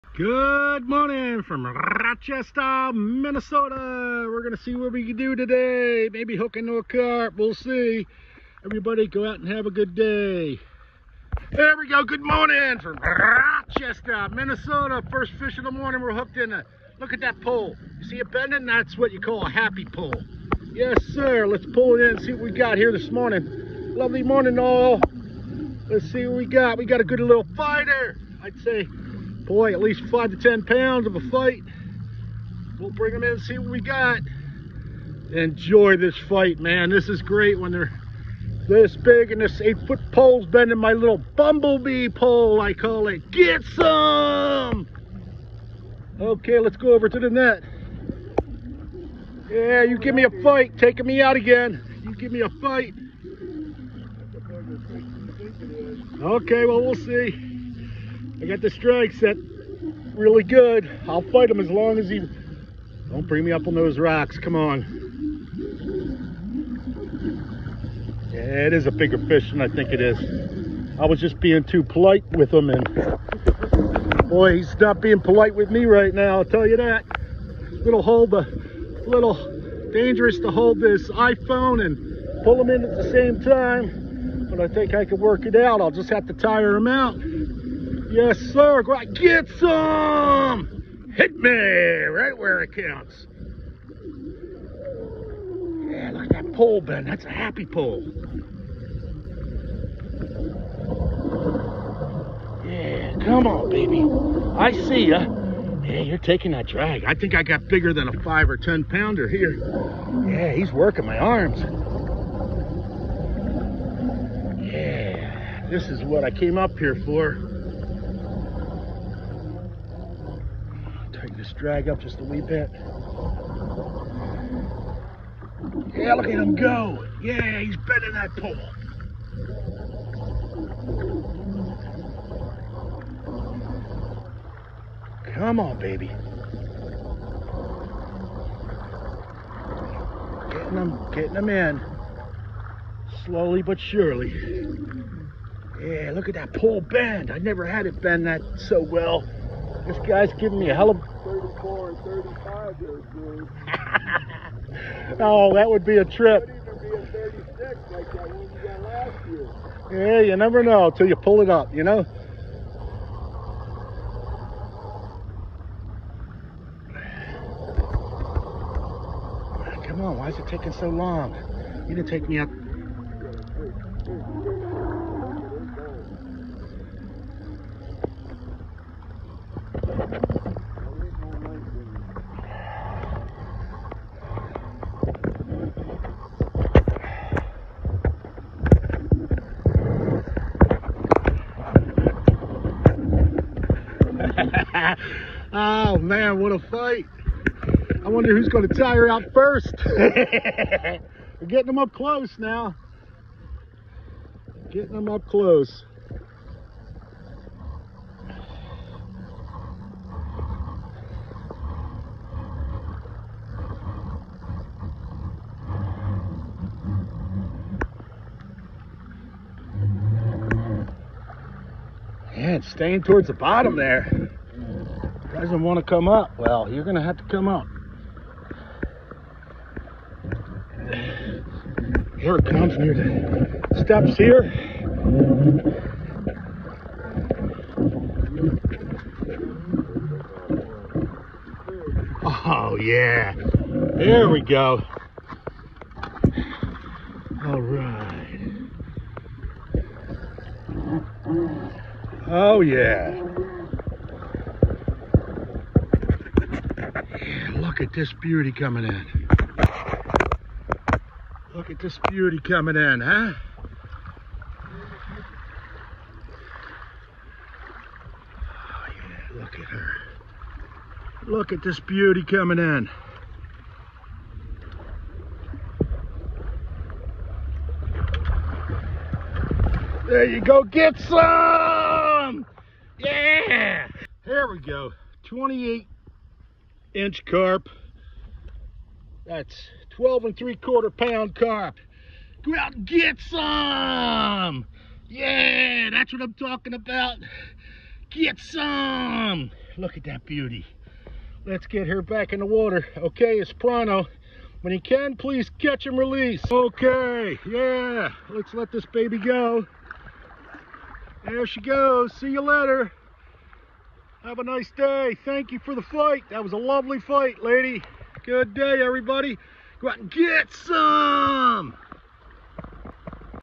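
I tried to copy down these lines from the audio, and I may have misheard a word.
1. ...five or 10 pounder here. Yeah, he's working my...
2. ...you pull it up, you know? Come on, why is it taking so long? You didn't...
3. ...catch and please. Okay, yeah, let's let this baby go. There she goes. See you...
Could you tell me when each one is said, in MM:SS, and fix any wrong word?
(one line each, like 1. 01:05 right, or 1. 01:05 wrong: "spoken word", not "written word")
1. 01:48 right
2. 02:41 right
3. 05:05 wrong: "release", not "please".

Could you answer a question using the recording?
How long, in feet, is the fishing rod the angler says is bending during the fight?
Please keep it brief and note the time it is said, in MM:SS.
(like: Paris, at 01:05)
8 feet, at 00:39.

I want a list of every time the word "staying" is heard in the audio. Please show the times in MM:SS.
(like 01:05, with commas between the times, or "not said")
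03:42.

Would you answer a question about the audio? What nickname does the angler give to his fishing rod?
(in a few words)
bumblebee pole.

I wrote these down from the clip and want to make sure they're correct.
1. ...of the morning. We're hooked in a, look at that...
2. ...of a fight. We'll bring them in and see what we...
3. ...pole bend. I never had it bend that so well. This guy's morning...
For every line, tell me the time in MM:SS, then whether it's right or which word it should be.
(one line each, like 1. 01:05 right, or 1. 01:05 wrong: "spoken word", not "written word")
1. 00:15 right
2. 00:31 right
3. 02:26 wrong: "giving", not "morning".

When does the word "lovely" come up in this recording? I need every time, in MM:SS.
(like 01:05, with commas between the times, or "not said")
00:23, 05:16.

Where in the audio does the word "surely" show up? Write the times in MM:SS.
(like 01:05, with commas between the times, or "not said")
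02:23.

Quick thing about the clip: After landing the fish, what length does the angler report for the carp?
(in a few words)
28 inches.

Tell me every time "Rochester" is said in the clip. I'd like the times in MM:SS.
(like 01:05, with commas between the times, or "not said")
00:01, 00:12.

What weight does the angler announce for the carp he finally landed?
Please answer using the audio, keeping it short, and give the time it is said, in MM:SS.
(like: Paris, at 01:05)
12 3/4 pounds, at 04:49.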